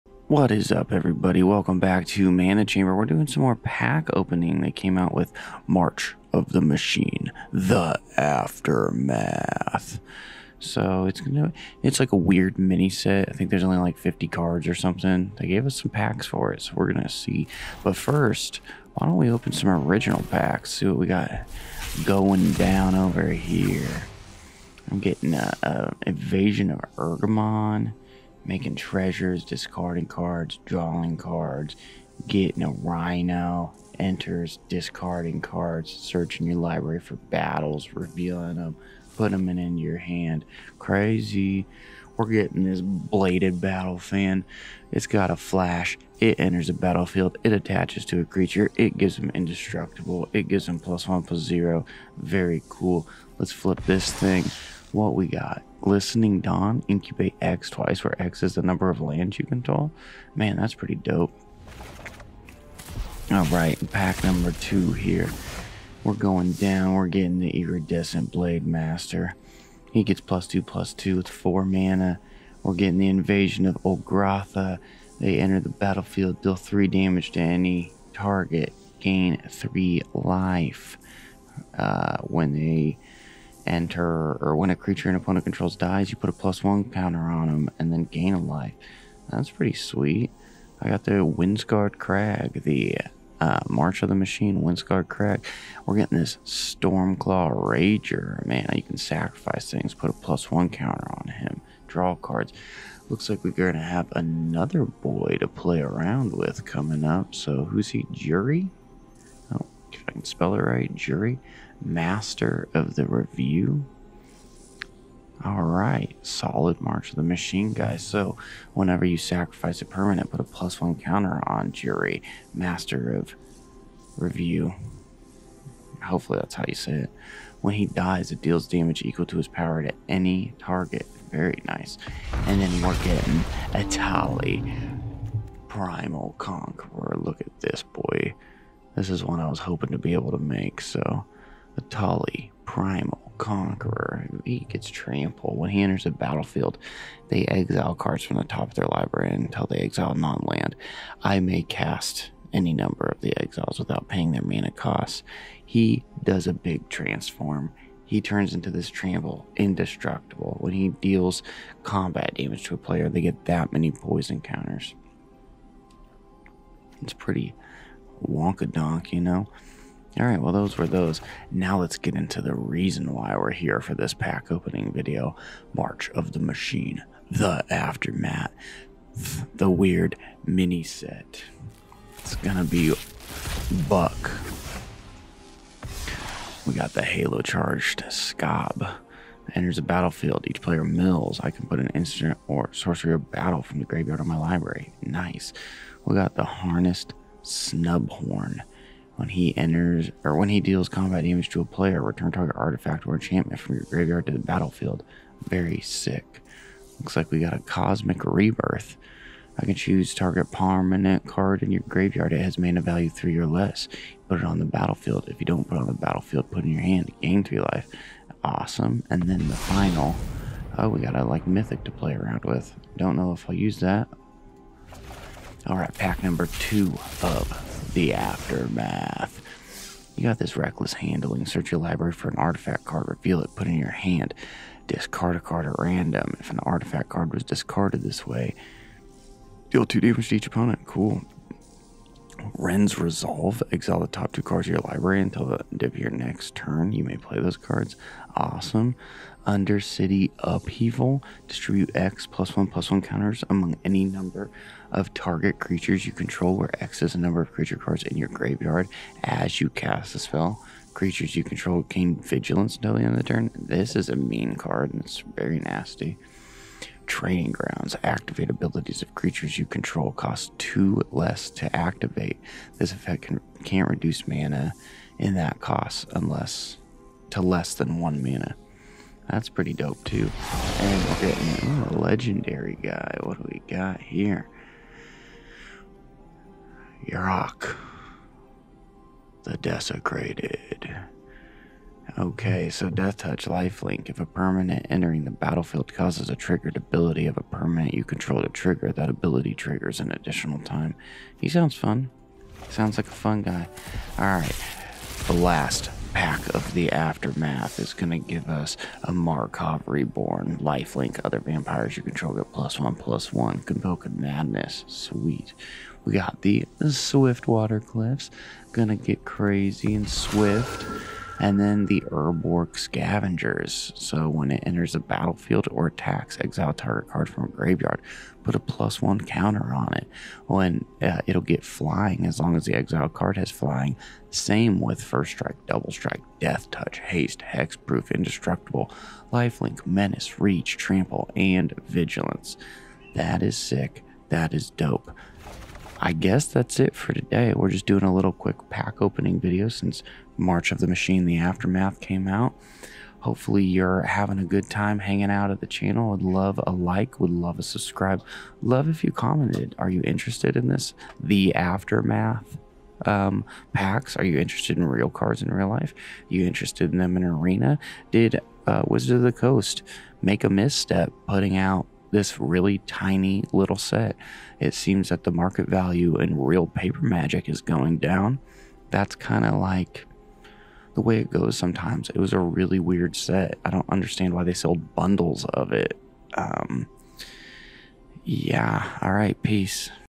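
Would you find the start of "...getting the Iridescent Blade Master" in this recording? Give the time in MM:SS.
01:07.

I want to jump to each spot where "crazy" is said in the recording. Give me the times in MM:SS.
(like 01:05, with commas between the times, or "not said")
00:40, 05:19.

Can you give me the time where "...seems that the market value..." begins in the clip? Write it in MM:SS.
06:14.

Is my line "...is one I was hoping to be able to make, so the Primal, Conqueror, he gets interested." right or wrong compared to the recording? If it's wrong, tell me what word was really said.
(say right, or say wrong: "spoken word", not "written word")
wrong: "trampled", not "interested".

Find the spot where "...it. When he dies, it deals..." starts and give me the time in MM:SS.
02:06.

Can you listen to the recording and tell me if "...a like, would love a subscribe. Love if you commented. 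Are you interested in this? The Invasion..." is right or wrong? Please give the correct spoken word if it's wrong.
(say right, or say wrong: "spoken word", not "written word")
wrong: "Aftermath", not "Invasion".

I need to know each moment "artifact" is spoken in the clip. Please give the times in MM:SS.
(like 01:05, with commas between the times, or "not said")
03:22, 03:52, 03:56.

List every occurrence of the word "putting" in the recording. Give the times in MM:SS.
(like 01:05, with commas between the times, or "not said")
00:39, 06:11.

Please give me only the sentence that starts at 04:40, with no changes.
And we're getting a legendary guy.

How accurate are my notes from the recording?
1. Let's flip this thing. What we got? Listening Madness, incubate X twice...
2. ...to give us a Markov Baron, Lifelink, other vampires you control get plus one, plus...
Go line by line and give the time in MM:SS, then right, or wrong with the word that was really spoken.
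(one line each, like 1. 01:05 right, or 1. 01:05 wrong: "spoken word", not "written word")
1. 00:53 wrong: "Dawn", not "Madness"
2. 05:08 right.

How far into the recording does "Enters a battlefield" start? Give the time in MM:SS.
03:09.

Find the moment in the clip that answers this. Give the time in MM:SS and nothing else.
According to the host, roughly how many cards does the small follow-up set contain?
00:13.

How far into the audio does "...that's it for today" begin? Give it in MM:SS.
05:46.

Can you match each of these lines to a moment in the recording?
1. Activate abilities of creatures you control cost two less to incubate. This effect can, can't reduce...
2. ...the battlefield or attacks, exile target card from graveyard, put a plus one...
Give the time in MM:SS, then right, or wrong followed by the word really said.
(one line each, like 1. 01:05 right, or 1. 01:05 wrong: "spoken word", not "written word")
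1. 04:28 wrong: "activate", not "incubate"
2. 05:24 right.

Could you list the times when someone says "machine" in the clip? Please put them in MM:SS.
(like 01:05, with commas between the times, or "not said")
00:06, 01:34, 01:57, 02:56, 05:50.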